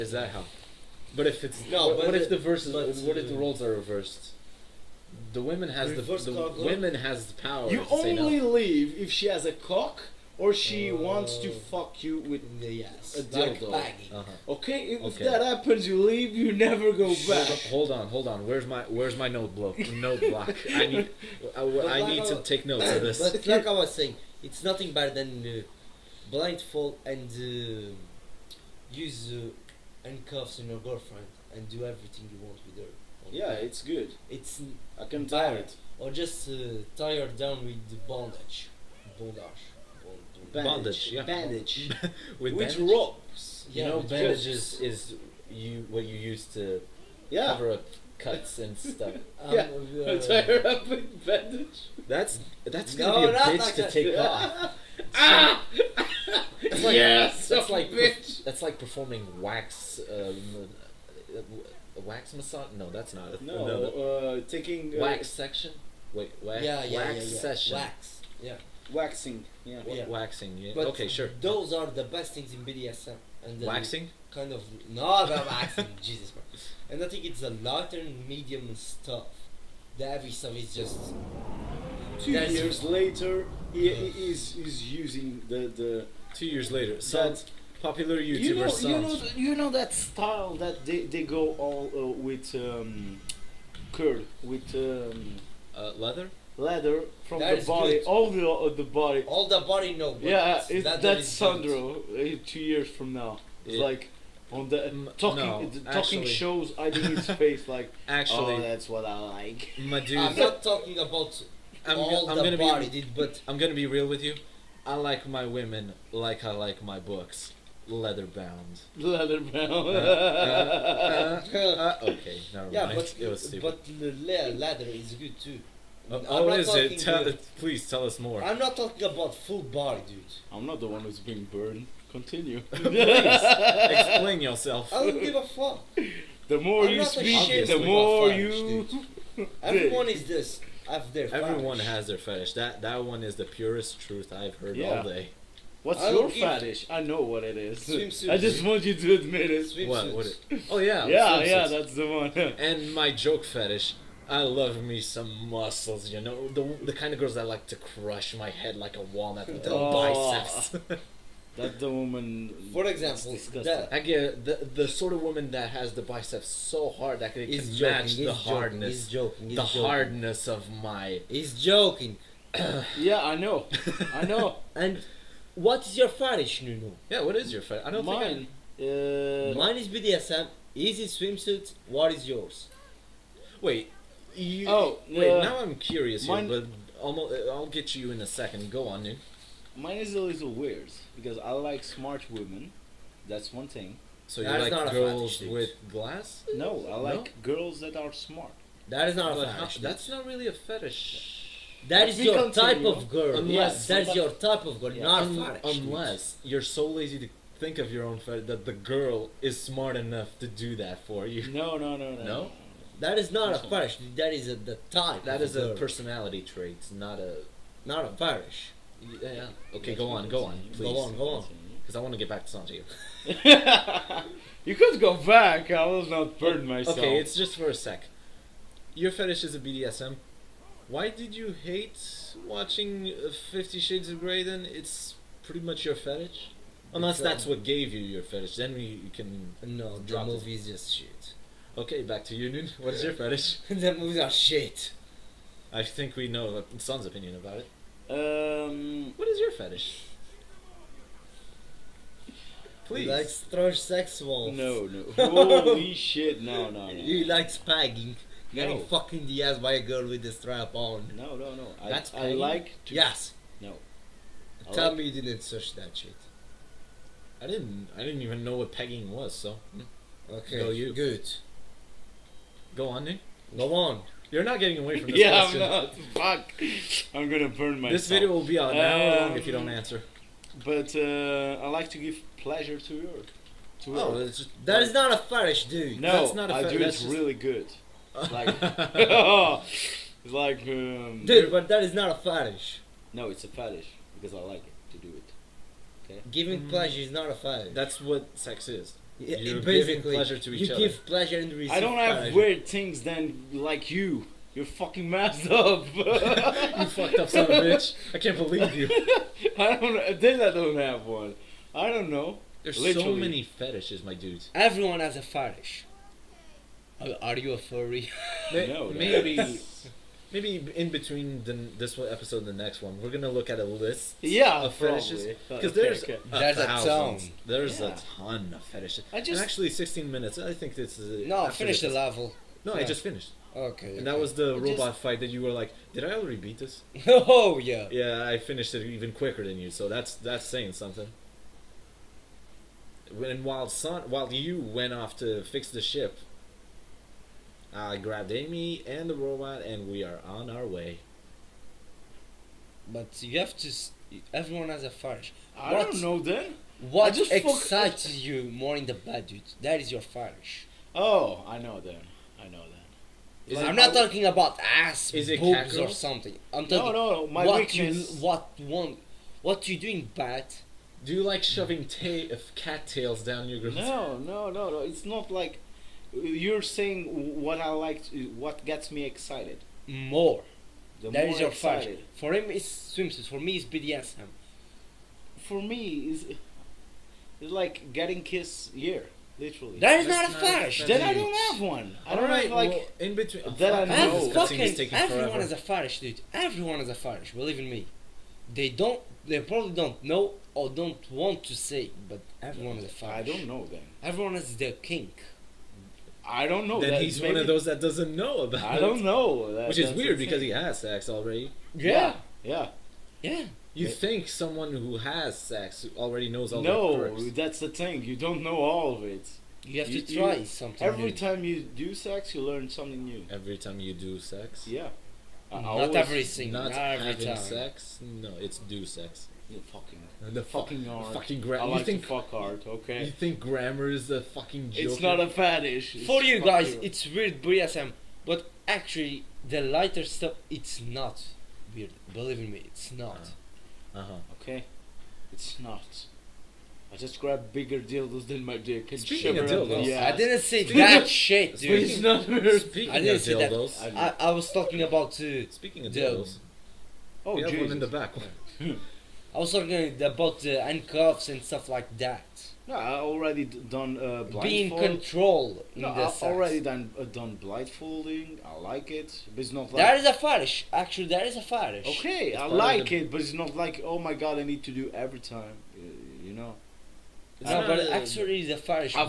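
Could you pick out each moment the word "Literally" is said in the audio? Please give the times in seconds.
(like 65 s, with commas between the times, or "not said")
312 s, 389 s.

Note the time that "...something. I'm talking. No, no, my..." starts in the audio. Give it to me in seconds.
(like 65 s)
365 s.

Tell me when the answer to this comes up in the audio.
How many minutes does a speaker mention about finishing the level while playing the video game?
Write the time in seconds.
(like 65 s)
329 s.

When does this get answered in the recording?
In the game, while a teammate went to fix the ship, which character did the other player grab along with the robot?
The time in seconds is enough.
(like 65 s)
348 s.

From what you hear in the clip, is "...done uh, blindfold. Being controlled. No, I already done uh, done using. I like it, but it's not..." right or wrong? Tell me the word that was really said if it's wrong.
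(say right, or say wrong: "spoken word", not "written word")
wrong: "blindfolding", not "using".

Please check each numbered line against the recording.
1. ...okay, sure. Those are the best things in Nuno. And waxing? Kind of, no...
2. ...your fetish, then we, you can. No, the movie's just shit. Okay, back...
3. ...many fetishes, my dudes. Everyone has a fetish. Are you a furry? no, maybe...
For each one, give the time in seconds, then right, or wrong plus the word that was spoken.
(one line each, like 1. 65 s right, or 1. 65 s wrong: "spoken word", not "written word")
1. 70 s wrong: "BDSM", not "Nuno"
2. 237 s right
3. 313 s right.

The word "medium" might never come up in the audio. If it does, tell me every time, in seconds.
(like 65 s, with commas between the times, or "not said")
78 s.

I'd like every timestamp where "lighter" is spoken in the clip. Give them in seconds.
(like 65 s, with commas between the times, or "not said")
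439 s.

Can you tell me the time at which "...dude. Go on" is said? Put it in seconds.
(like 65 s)
273 s.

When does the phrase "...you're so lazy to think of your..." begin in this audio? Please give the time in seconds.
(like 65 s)
206 s.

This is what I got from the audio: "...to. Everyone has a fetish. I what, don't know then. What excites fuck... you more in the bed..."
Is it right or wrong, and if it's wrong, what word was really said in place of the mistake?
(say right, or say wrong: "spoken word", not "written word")
right.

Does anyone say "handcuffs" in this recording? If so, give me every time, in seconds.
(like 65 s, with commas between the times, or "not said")
30 s, 460 s.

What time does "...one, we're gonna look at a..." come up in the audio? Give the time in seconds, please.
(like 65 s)
322 s.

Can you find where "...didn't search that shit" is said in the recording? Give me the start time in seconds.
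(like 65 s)
265 s.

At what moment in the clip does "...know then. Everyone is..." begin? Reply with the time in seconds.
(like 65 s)
403 s.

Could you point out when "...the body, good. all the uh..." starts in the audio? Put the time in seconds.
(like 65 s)
97 s.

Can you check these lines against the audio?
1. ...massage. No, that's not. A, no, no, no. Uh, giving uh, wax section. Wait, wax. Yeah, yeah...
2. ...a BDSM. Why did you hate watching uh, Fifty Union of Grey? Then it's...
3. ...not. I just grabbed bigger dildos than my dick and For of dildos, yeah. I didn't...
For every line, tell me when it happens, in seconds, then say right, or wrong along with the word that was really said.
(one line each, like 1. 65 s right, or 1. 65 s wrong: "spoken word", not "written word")
1. 62 s wrong: "taking", not "giving"
2. 229 s wrong: "Shades", not "Union"
3. 445 s wrong: "Speaking", not "For".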